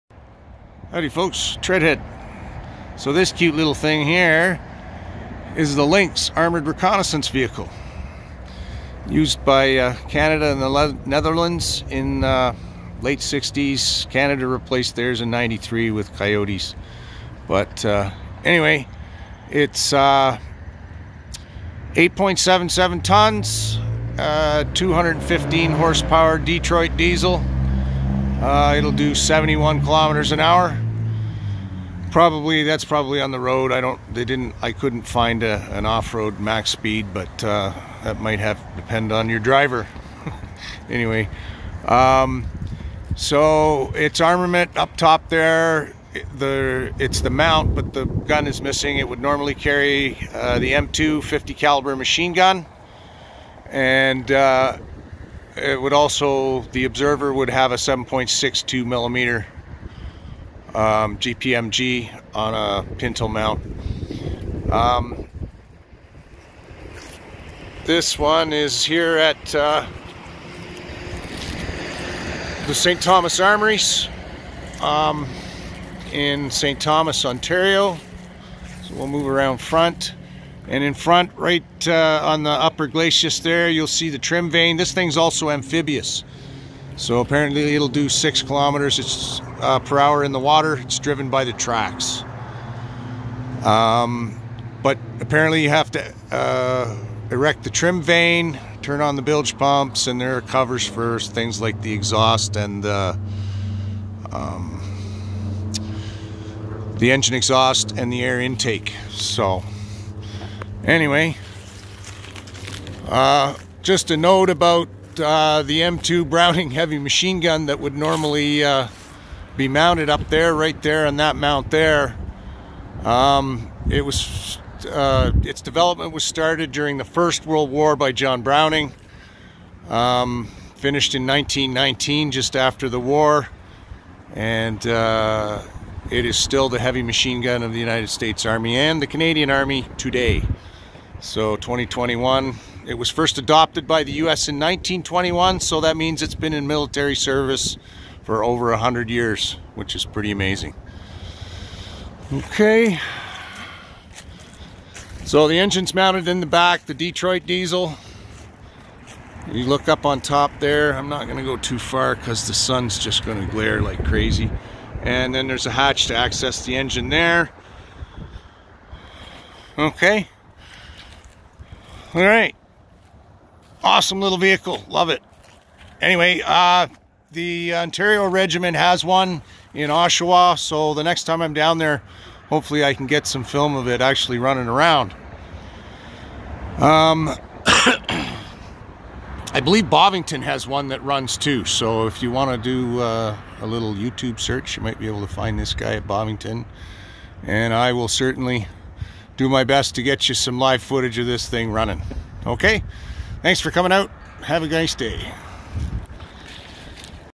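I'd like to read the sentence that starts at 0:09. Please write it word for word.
Used by uh, Canada and the Le Netherlands in uh, late 60s.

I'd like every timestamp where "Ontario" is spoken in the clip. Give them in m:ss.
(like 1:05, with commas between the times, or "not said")
1:17, 2:57.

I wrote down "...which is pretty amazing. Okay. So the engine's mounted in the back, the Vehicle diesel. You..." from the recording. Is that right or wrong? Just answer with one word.
wrong.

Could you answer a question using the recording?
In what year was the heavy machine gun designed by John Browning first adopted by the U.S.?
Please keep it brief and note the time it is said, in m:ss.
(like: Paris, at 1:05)
1921, at 2:24.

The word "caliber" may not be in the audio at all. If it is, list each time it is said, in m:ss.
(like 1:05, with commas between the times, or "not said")
0:51.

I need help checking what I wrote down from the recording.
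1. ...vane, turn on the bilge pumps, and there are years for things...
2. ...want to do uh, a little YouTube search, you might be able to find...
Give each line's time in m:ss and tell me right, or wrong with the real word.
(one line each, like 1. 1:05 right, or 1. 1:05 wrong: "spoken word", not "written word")
1. 1:38 wrong: "covers", not "years"
2. 3:12 right.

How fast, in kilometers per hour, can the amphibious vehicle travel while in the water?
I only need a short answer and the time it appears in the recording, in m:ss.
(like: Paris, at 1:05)
6 km/h, at 1:28.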